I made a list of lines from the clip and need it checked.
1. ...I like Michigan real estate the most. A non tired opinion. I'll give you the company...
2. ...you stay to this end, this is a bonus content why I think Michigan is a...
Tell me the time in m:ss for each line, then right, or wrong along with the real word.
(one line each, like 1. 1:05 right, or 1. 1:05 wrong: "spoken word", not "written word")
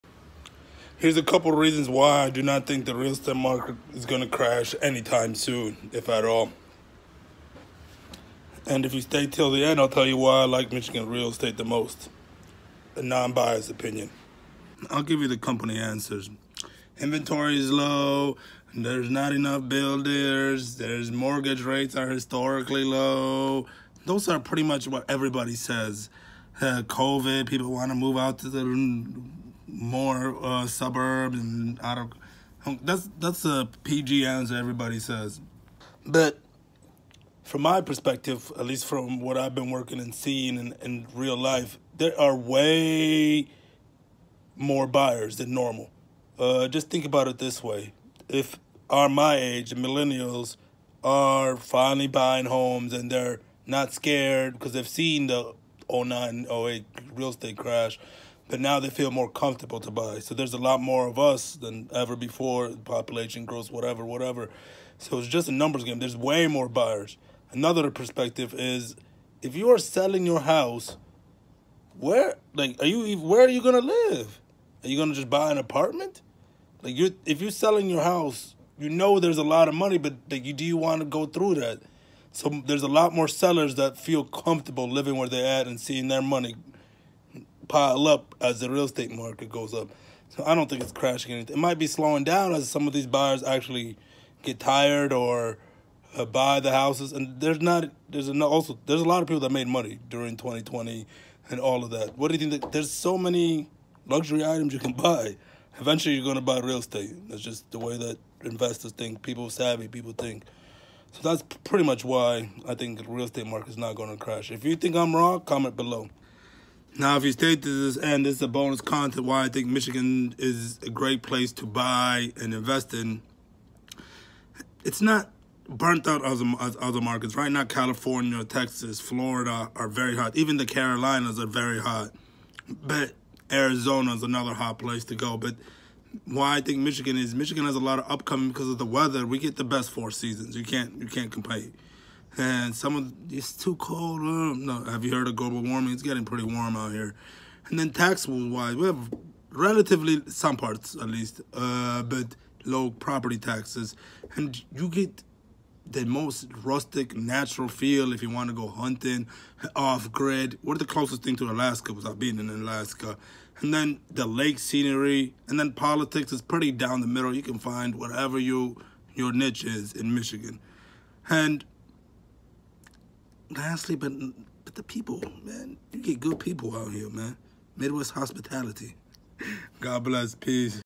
1. 0:10 wrong: "biased", not "tired"
2. 1:57 right.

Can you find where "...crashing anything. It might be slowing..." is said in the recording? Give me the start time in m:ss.
1:30.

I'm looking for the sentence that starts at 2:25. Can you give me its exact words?
It's getting pretty warm out here.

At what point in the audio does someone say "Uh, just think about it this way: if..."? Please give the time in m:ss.
0:46.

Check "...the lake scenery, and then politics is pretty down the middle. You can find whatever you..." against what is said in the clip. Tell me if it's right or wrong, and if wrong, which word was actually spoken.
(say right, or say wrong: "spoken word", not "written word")
right.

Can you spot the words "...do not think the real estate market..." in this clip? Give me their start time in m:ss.
0:02.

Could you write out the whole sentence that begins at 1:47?
That's just the way that investors think.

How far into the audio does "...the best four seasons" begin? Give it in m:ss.
2:19.